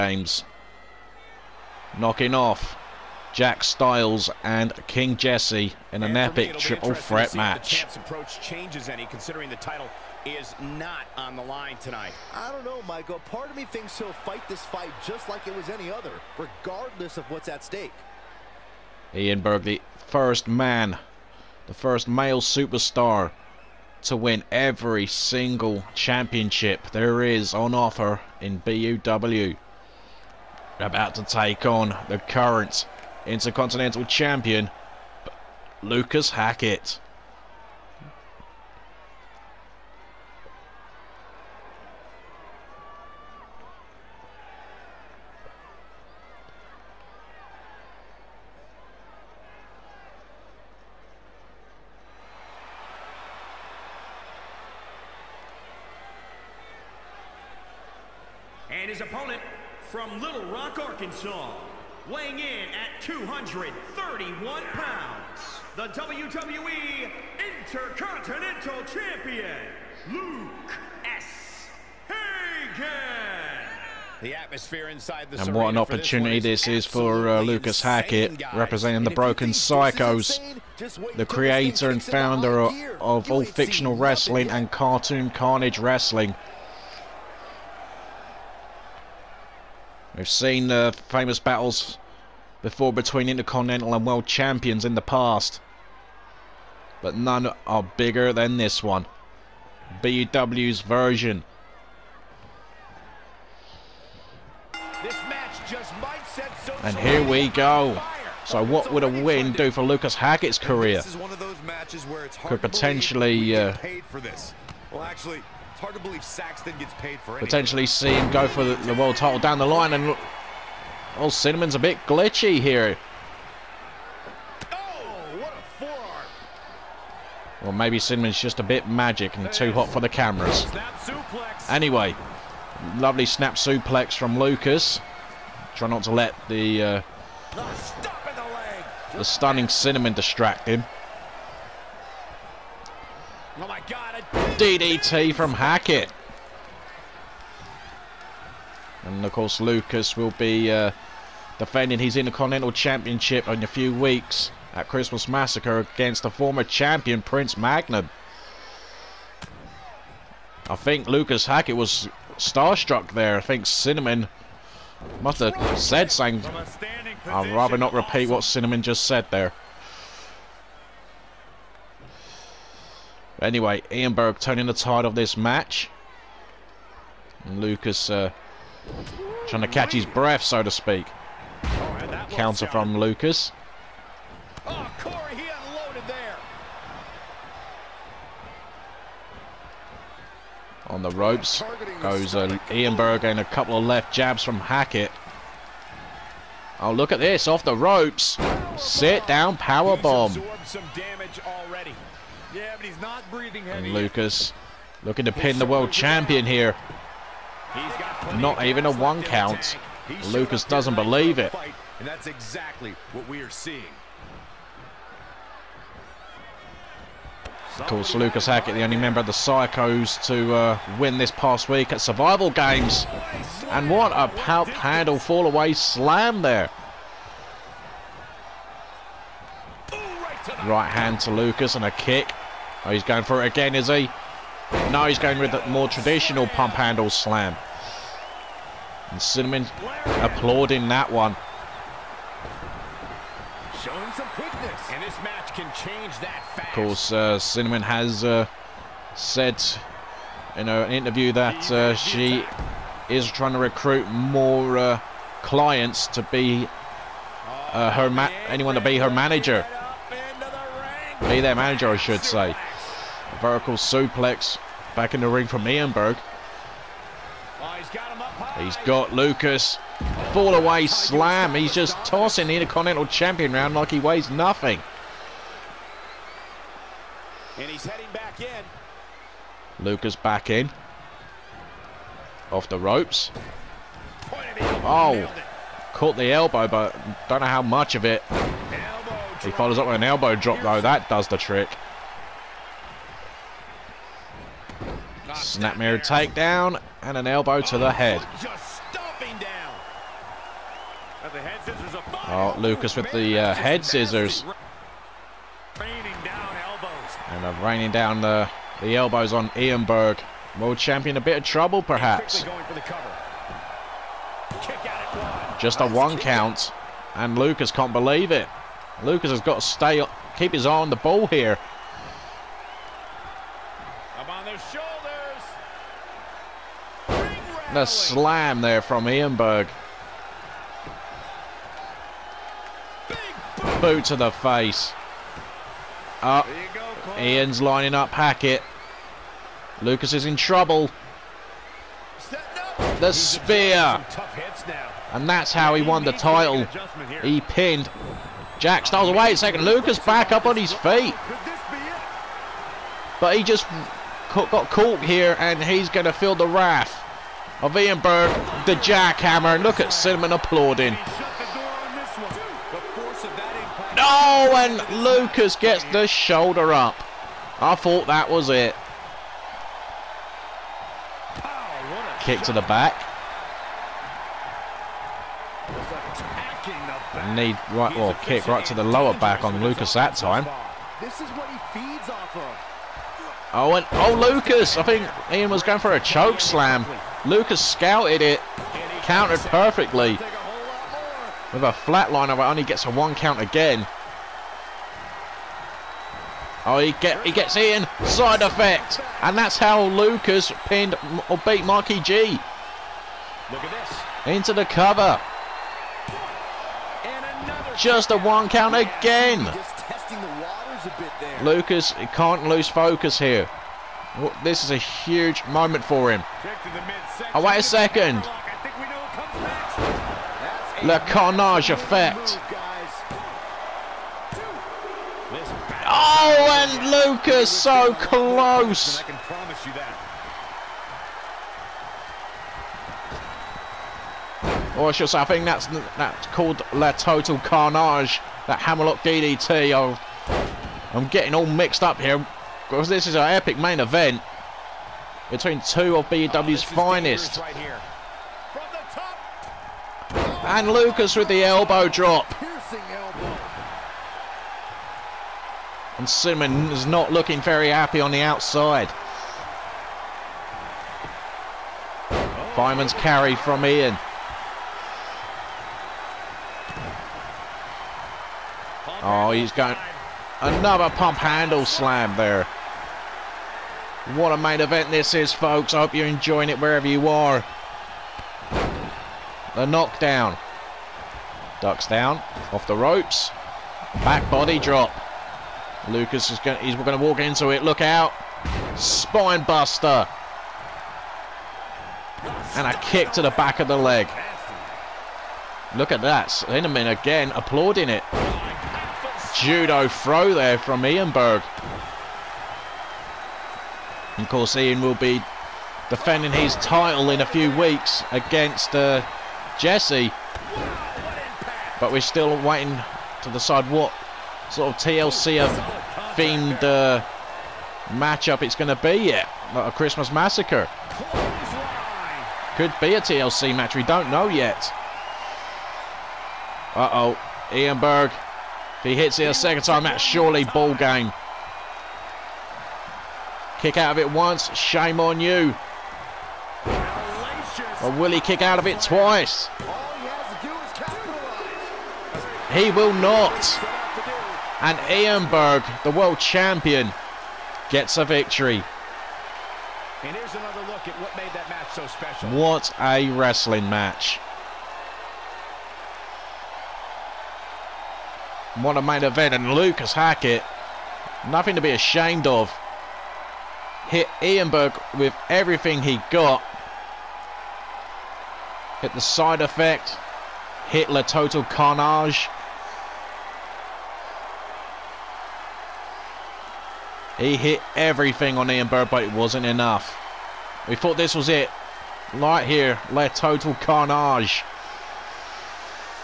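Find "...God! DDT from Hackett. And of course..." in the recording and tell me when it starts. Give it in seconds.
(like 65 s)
143 s.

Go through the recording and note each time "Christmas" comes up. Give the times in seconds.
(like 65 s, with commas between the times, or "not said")
154 s, 519 s.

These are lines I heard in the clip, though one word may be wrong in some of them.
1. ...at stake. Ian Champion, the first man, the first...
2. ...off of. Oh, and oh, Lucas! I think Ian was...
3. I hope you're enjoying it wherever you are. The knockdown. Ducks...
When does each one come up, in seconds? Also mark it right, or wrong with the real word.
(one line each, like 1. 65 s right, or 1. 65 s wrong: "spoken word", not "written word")
1. 17 s wrong: "Berg", not "Champion"
2. 382 s right
3. 475 s right.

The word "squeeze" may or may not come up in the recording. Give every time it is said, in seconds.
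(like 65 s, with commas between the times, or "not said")
not said.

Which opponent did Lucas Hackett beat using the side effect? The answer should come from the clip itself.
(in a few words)
Marky G.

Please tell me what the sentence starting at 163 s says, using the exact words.
I think Cinnamon must have said something.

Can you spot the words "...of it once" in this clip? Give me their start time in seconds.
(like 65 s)
533 s.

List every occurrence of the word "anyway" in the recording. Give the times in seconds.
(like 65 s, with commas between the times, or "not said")
131 s, 173 s.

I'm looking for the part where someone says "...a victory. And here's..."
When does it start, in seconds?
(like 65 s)
547 s.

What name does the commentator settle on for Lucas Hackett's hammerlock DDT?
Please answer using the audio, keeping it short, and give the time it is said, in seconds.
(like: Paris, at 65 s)
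Le Total Carnage, at 436 s.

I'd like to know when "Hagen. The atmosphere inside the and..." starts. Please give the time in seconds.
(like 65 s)
72 s.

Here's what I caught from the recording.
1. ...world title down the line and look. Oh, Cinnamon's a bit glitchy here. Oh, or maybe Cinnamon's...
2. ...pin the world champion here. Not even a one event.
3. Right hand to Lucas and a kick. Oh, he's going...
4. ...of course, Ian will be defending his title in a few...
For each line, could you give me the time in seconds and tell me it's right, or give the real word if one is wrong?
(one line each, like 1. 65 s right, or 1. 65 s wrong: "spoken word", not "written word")
1. 118 s right
2. 205 s wrong: "count", not "event"
3. 230 s right
4. 504 s right.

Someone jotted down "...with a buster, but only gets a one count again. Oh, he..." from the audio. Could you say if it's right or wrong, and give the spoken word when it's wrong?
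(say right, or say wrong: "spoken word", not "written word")
wrong: "flatliner", not "buster".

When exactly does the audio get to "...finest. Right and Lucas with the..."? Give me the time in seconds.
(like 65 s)
446 s.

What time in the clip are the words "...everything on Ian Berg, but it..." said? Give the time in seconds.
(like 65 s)
577 s.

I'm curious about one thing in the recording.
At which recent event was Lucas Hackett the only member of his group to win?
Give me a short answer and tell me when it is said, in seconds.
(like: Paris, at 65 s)
Survival Games, at 222 s.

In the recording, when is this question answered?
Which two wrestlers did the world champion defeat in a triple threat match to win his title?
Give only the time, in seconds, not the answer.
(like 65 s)
3 s.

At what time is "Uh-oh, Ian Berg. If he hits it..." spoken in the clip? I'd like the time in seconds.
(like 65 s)
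526 s.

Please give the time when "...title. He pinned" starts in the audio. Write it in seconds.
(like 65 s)
346 s.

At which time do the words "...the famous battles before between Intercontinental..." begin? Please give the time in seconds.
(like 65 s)
90 s.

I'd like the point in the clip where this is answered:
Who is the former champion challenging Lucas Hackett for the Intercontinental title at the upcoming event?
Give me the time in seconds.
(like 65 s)
157 s.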